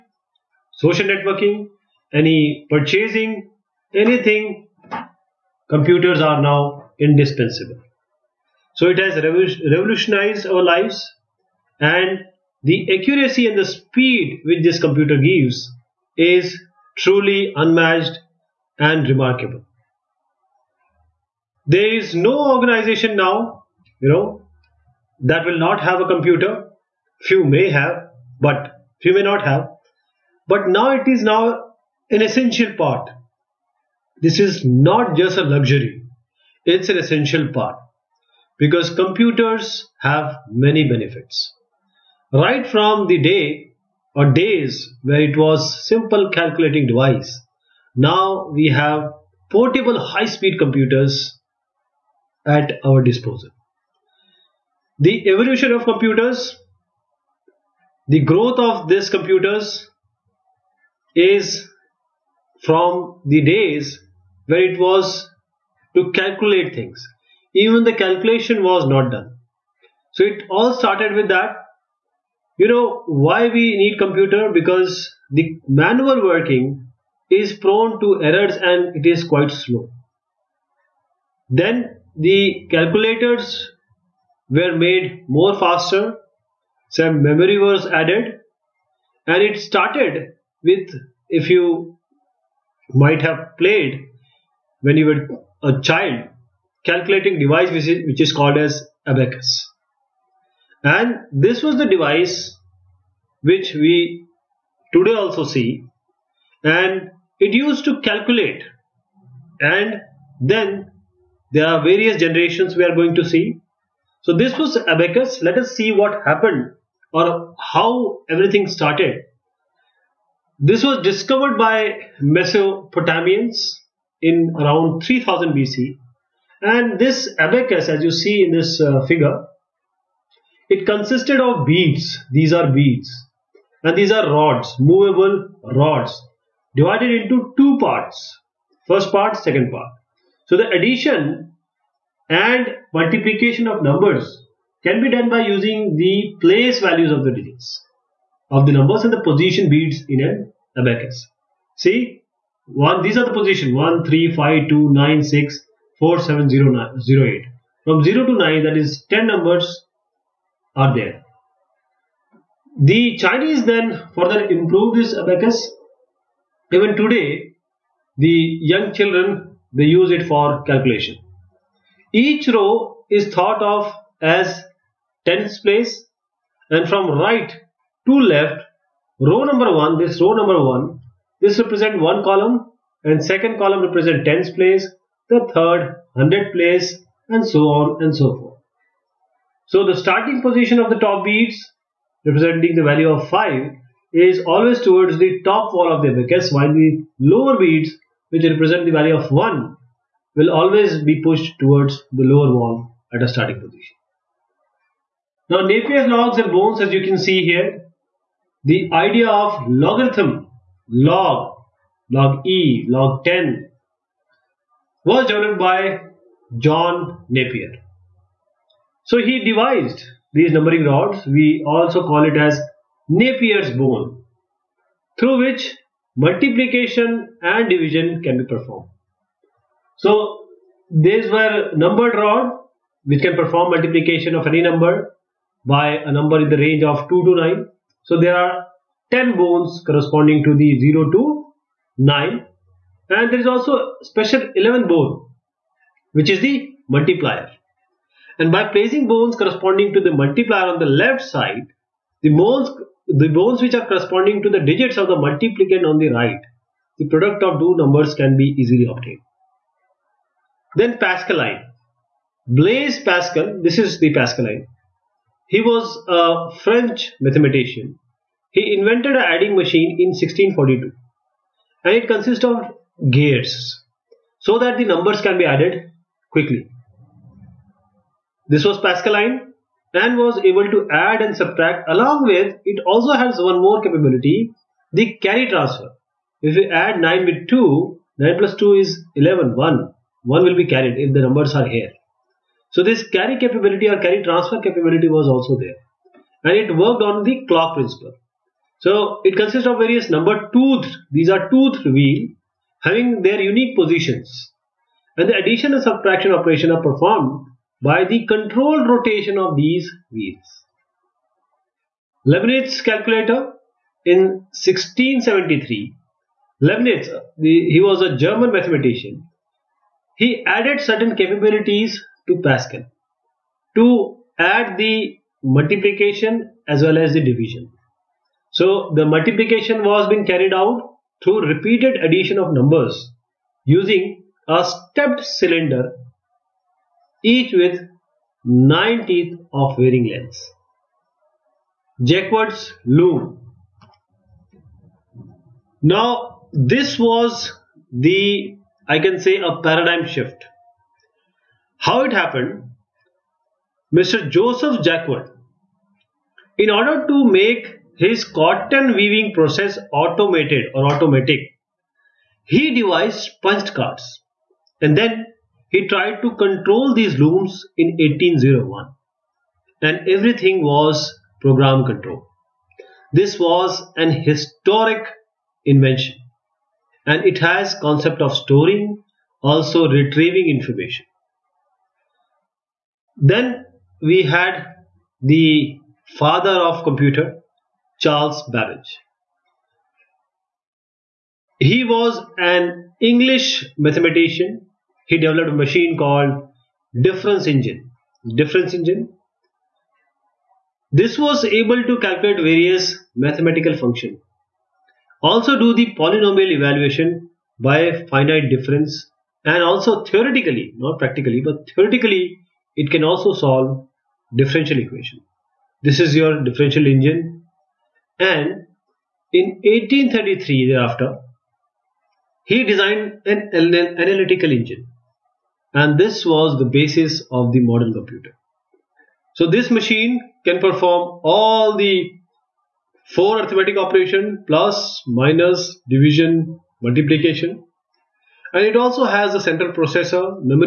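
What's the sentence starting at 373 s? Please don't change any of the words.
This was an historic invention and it has concept of storing also retrieving information.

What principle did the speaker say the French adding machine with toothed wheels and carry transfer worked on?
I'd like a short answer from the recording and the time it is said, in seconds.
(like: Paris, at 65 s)
clock principle, at 297 s.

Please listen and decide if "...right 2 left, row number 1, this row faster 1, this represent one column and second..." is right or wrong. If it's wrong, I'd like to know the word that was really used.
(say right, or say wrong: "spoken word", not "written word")
wrong: "number", not "faster".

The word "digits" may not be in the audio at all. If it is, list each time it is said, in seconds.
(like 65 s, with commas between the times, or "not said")
147 s, 254 s.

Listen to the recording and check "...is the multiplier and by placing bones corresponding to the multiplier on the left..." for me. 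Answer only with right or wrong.
right.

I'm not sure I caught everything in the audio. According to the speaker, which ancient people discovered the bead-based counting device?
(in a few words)
Mesopotamians.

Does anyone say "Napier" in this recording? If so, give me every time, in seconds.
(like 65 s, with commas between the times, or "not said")
205 s, 217 s, 223 s.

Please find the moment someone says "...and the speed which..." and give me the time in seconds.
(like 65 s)
13 s.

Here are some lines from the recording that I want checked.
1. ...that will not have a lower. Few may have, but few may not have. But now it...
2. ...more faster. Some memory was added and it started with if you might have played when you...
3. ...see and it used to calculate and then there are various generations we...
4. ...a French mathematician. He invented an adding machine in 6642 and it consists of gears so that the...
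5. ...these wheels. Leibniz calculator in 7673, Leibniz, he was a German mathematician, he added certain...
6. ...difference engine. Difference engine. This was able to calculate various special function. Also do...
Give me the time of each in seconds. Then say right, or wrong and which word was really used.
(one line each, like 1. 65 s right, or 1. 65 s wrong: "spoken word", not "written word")
1. 25 s wrong: "computer", not "lower"
2. 85 s right
3. 105 s right
4. 266 s wrong: "1642", not "6642"
5. 309 s wrong: "1673", not "7673"
6. 397 s wrong: "mathematical", not "special".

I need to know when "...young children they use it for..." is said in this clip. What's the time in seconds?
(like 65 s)
168 s.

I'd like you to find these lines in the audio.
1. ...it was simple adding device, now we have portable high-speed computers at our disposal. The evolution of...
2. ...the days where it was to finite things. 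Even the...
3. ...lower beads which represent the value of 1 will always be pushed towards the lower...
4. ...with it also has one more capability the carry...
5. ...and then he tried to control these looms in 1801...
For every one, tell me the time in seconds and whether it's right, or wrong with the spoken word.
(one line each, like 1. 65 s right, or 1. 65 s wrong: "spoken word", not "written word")
1. 45 s wrong: "calculating", not "adding"
2. 63 s wrong: "calculate", not "finite"
3. 197 s right
4. 282 s right
5. 364 s right.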